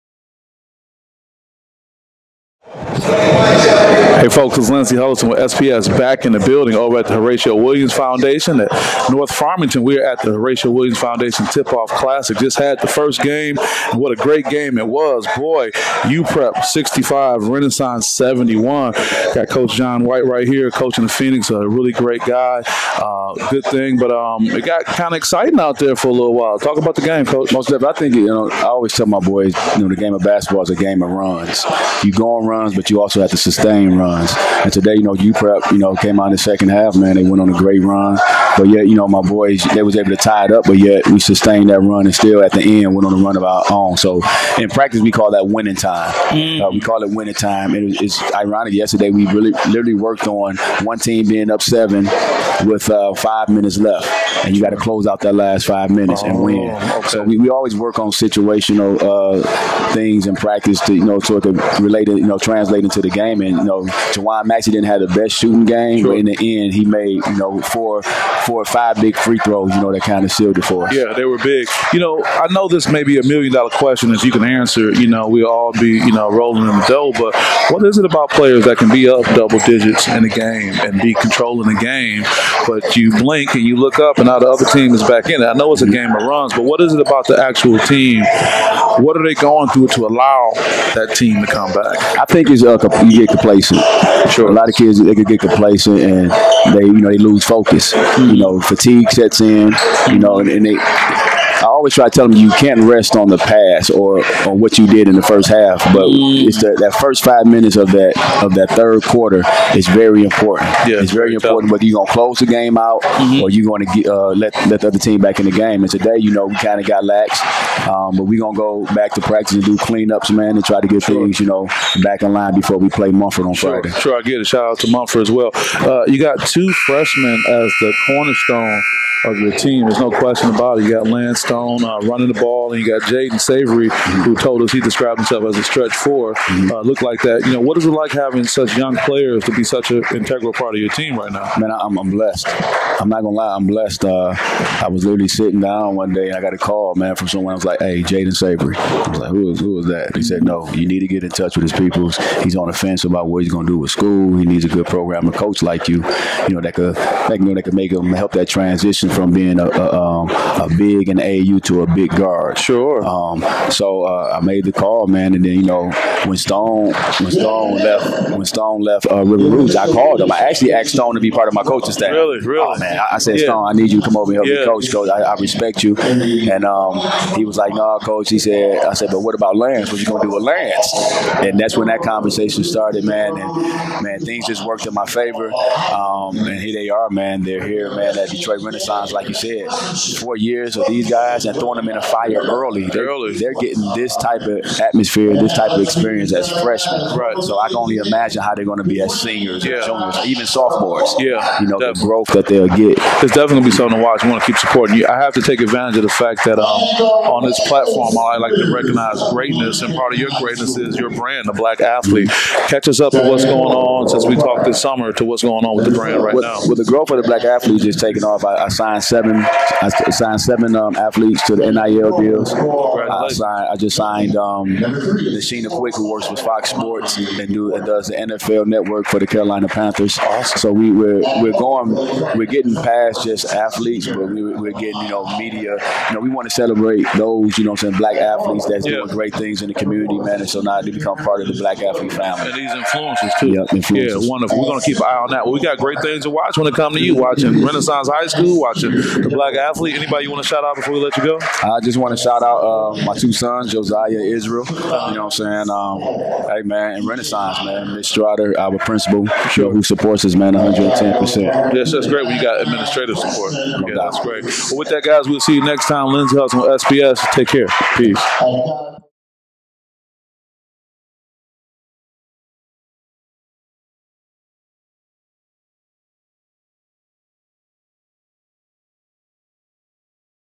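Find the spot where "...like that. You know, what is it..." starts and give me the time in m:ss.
2:17.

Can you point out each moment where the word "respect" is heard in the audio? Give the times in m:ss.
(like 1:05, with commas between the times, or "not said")
2:55.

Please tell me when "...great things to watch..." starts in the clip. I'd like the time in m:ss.
4:05.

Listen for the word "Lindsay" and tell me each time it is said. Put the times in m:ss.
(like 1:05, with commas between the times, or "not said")
0:04, 4:26.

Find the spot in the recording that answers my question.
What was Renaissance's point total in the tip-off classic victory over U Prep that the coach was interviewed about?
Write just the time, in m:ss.
0:18.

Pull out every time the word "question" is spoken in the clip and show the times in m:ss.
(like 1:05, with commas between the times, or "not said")
1:13, 2:10.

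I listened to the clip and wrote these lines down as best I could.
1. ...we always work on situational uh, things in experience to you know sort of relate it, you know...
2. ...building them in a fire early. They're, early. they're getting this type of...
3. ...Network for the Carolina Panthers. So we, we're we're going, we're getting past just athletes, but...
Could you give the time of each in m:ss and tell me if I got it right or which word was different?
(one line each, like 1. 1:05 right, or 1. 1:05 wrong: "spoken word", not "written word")
1. 0:57 wrong: "practice", not "experience"
2. 3:11 wrong: "throwing", not "building"
3. 3:48 right.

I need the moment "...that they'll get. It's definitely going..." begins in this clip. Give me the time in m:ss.
3:22.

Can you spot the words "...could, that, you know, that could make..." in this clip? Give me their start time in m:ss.
2:36.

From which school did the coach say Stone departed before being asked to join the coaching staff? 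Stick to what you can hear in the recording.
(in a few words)
River Rouge.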